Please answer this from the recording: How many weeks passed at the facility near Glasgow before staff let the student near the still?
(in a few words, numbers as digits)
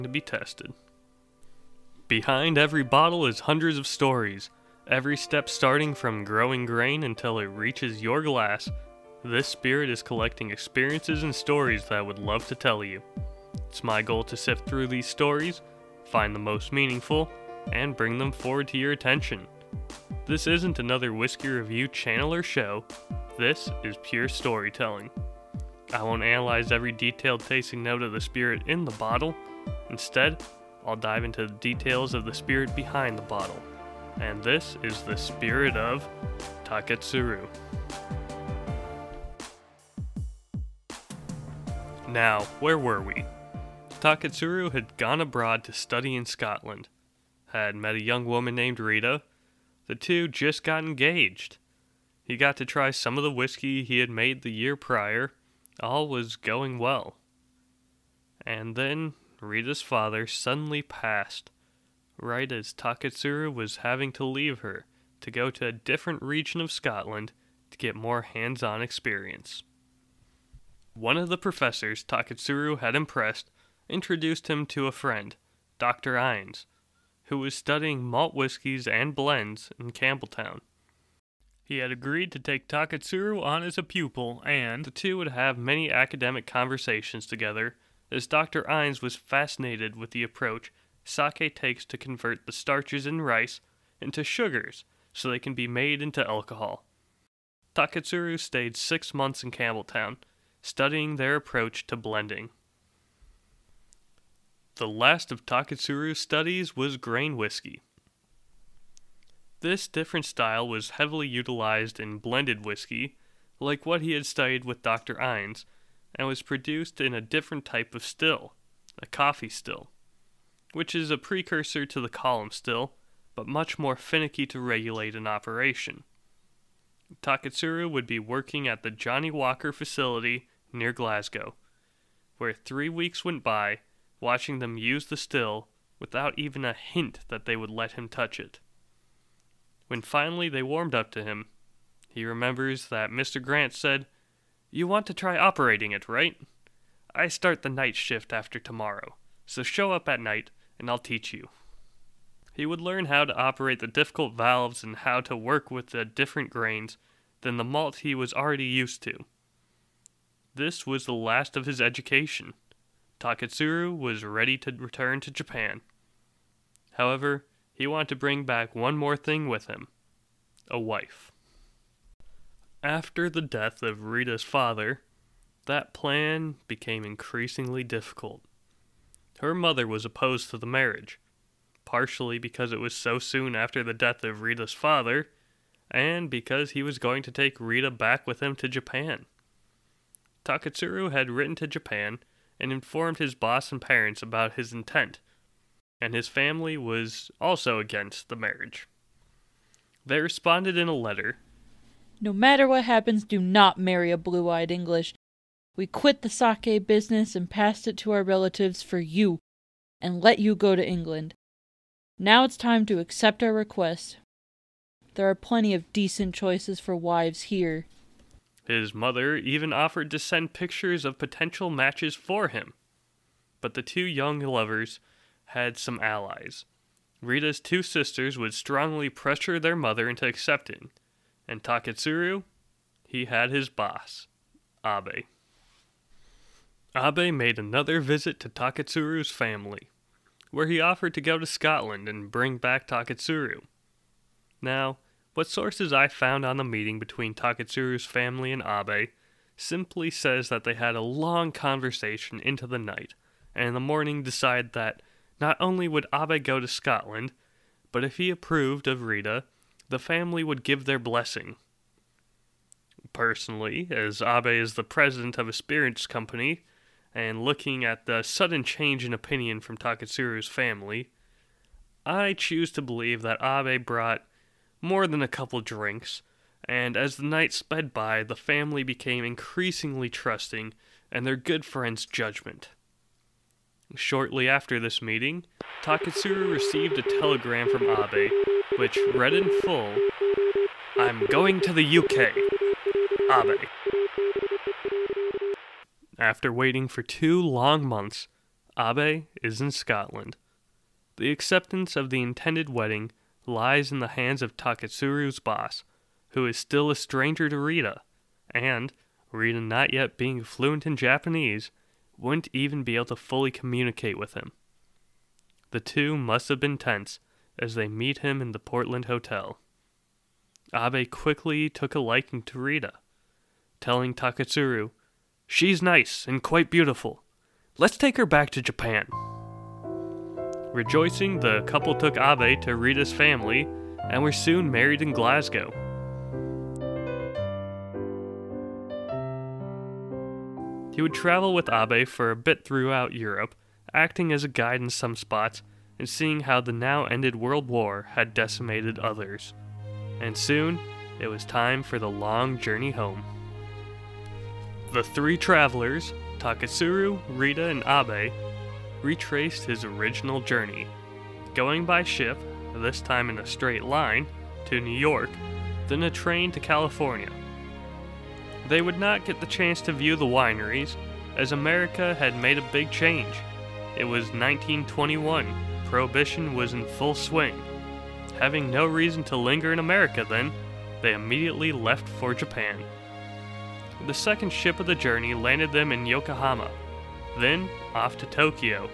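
3.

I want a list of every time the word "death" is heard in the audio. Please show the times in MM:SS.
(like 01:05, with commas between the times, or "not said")
02:53, 03:03.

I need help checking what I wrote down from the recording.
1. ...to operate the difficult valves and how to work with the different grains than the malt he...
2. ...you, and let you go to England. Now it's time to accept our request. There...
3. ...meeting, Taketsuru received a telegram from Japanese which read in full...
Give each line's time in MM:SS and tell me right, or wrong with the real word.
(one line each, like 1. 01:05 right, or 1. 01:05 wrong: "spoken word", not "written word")
1. 02:33 right
2. 03:28 right
3. 04:44 wrong: "Abe", not "Japanese".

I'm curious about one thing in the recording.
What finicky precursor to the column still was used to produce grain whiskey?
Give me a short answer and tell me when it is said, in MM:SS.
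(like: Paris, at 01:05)
coffee still, at 01:59.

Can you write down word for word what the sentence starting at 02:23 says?
Grant said, you want to try operating it, right?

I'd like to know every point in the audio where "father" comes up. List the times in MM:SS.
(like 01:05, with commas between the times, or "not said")
00:59, 02:54, 03:04.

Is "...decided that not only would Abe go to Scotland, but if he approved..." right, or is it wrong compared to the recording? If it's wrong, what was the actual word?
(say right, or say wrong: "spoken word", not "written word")
right.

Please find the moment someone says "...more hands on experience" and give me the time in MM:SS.
01:07.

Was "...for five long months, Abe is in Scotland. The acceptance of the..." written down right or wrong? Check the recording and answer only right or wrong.
wrong.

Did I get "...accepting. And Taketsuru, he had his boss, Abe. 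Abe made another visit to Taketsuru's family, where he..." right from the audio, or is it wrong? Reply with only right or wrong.
right.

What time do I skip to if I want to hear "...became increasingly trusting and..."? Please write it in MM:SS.
04:38.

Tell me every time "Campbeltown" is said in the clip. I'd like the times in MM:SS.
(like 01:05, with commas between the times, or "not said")
01:19, 01:39.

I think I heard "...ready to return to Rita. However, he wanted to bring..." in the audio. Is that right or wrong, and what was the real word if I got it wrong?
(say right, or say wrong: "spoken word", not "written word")
wrong: "Japan", not "Rita".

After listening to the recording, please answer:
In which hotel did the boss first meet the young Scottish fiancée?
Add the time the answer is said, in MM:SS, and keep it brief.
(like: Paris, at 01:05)
Portland Hotel, at 05:18.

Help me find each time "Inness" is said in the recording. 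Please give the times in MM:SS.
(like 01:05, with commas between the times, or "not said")
01:16, 01:28, 01:55.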